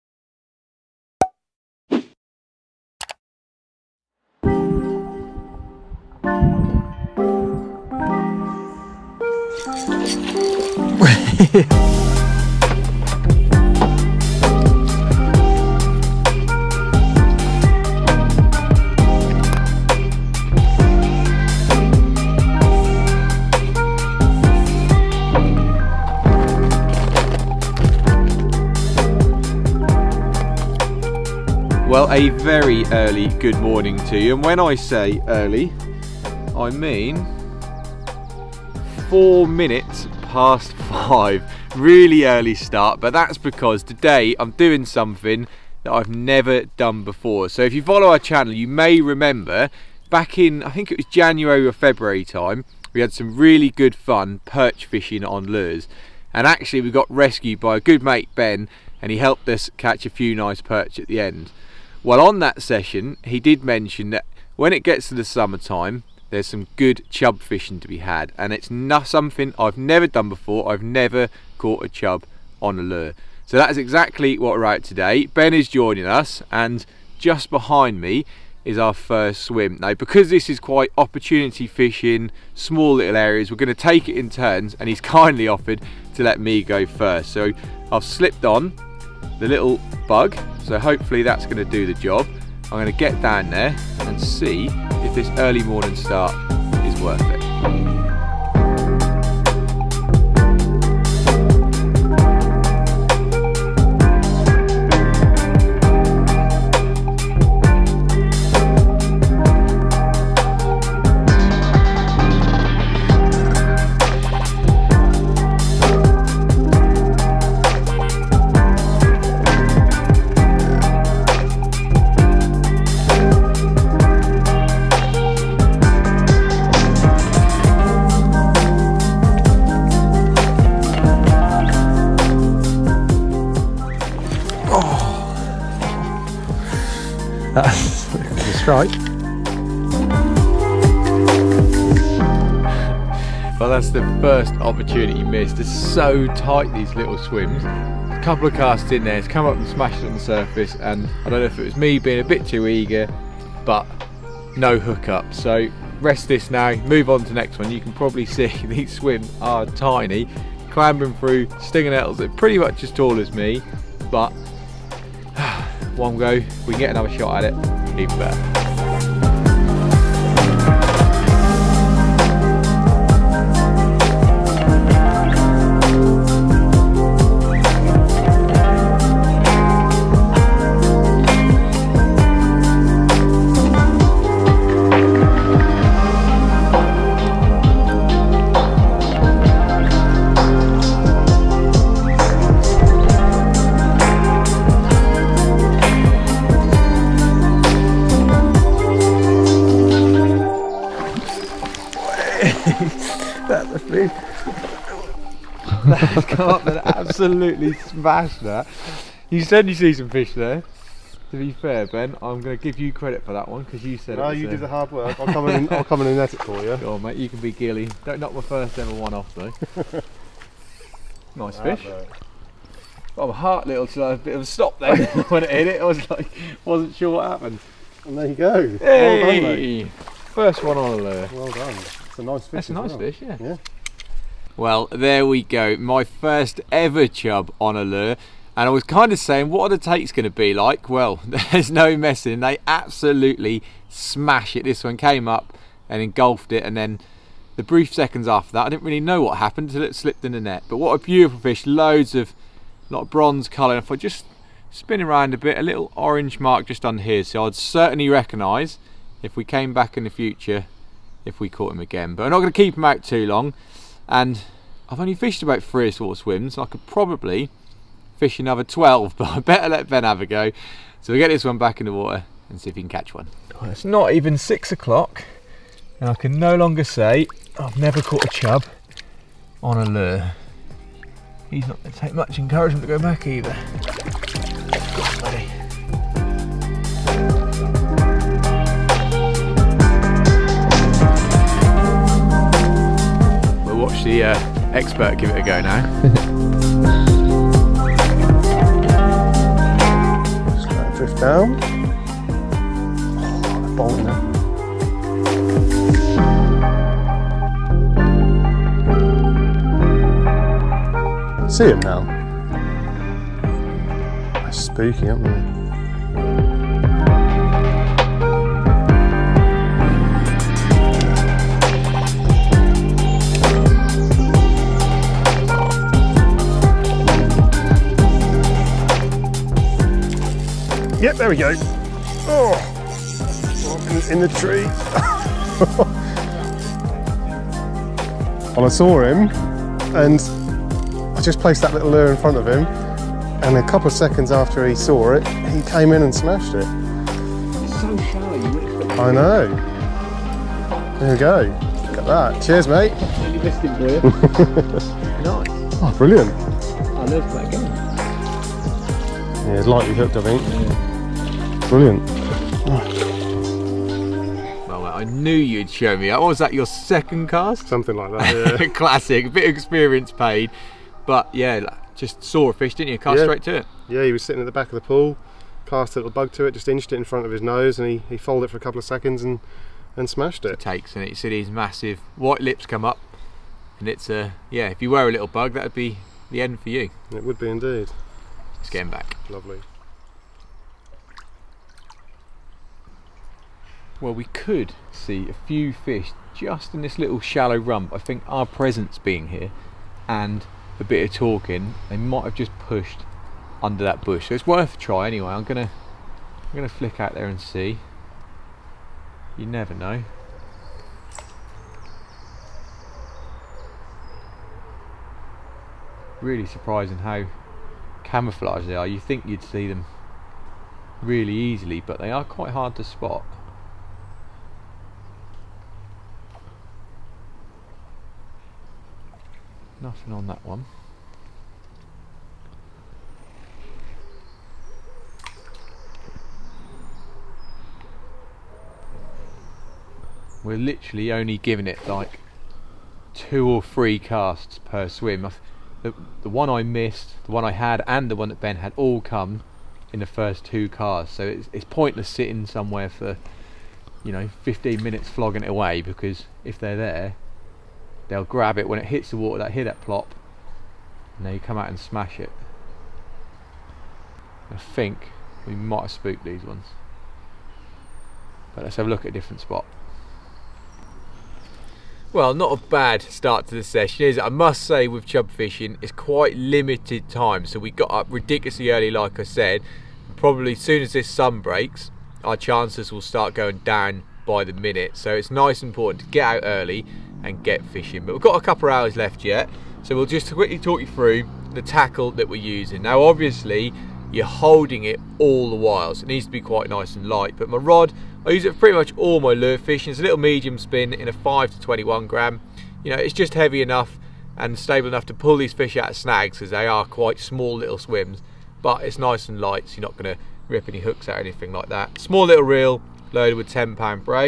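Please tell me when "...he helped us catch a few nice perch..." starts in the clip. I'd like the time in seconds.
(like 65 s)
59 s.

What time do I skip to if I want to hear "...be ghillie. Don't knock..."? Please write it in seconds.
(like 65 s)
217 s.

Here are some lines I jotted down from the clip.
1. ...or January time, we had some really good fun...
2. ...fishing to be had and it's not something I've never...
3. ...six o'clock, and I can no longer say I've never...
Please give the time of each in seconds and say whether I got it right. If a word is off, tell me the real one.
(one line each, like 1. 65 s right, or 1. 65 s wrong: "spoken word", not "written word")
1. 51 s wrong: "February", not "January"
2. 67 s right
3. 274 s right.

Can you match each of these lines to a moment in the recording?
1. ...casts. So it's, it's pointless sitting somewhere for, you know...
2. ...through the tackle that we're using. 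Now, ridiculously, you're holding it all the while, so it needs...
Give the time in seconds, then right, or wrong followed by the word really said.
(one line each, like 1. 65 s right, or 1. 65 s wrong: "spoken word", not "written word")
1. 450 s right
2. 490 s wrong: "obviously", not "ridiculously".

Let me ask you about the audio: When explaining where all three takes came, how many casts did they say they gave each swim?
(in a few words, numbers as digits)
2 or 3.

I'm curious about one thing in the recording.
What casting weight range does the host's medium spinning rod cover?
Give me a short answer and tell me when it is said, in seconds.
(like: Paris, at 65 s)
5 to 21 gram, at 501 s.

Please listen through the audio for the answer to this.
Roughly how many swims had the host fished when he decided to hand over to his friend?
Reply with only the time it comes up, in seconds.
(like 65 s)
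265 s.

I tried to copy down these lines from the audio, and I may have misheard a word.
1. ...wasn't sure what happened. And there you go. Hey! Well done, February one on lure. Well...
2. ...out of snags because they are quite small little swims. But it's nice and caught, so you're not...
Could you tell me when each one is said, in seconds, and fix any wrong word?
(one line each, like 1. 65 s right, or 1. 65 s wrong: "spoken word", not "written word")
1. 226 s wrong: "First", not "February"
2. 505 s wrong: "light", not "caught".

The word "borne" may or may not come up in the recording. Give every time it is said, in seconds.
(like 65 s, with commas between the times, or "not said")
not said.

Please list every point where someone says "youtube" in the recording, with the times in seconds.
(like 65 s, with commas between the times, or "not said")
not said.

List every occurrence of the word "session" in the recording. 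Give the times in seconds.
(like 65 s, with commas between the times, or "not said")
62 s, 473 s.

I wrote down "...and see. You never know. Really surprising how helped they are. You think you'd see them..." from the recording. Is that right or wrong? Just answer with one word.
wrong.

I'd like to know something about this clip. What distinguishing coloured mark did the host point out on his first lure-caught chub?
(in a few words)
little orange mark.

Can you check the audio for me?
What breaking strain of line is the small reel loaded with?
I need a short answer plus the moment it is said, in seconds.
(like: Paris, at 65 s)
10 pound, at 513 s.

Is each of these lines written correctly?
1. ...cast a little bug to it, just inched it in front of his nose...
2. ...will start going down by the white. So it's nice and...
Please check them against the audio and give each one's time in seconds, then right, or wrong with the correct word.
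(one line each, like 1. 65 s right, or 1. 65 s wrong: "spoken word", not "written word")
1. 375 s right
2. 482 s wrong: "minute", not "white".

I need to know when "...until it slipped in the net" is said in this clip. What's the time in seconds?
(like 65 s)
249 s.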